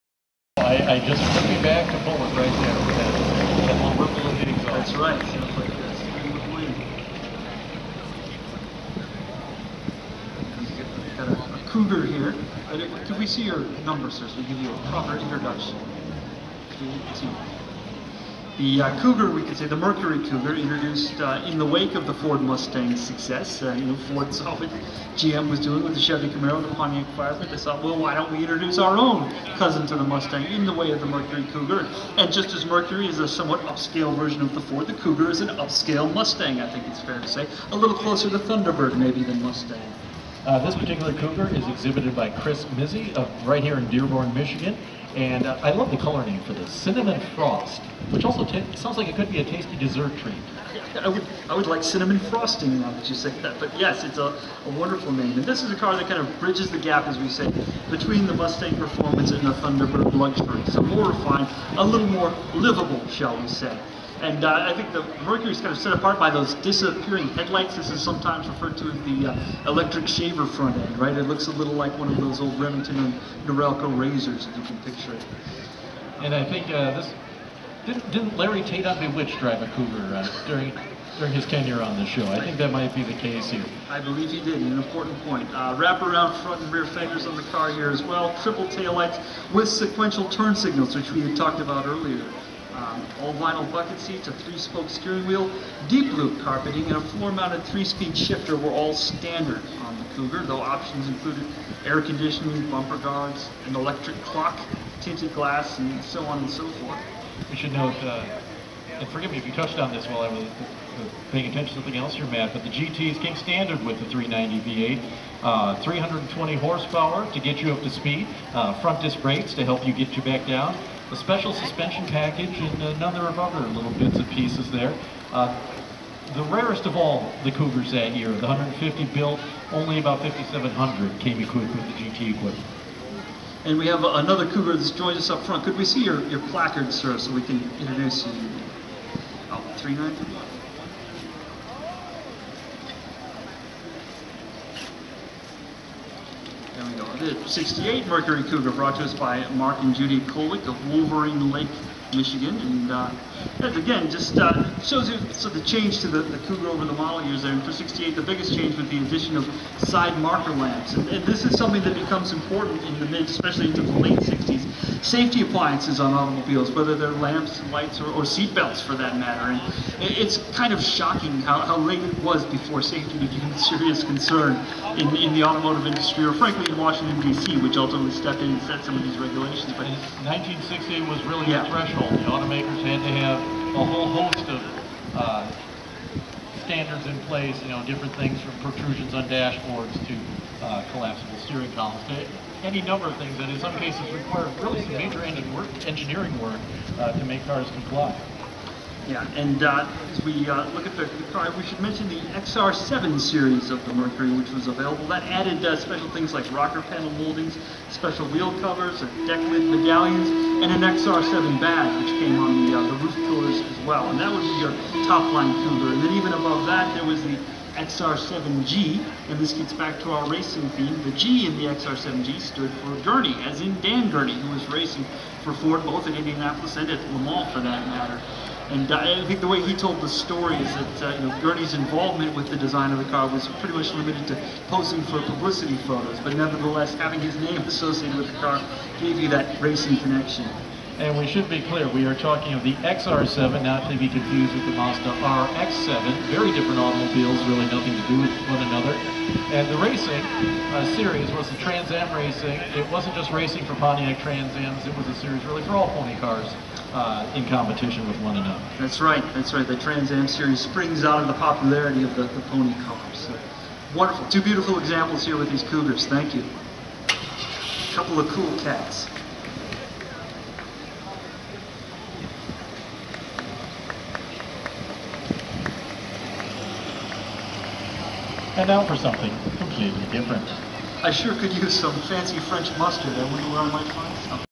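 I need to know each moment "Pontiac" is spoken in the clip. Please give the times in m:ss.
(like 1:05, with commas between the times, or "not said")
0:26, 4:13.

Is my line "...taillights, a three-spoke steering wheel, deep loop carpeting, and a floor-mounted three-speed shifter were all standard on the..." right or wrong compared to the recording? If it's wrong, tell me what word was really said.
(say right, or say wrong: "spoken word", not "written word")
wrong: "seats", not "taillights".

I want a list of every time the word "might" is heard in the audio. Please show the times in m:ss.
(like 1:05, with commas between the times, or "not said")
1:22, 4:43.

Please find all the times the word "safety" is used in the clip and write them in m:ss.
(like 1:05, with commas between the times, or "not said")
2:45, 2:52.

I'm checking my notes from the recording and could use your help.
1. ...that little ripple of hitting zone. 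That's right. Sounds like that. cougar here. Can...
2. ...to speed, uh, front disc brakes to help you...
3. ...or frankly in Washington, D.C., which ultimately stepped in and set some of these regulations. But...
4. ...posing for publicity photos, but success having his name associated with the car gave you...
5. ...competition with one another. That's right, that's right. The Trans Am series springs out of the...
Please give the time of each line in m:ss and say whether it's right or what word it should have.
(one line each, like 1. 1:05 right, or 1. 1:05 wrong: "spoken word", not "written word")
1. 0:03 right
2. 1:57 right
3. 2:56 right
4. 3:54 wrong: "nevertheless", not "success"
5. 4:17 right.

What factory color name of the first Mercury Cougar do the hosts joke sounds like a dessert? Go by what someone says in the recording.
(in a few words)
Cinnamon Frost.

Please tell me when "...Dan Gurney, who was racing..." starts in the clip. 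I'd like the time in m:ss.
3:43.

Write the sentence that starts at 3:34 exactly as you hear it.
And that would be your top line Cougar.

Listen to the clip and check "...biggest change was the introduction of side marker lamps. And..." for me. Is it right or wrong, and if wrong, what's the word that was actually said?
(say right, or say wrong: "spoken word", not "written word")
wrong: "addition", not "introduction".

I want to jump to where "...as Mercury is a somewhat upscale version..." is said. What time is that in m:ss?
0:32.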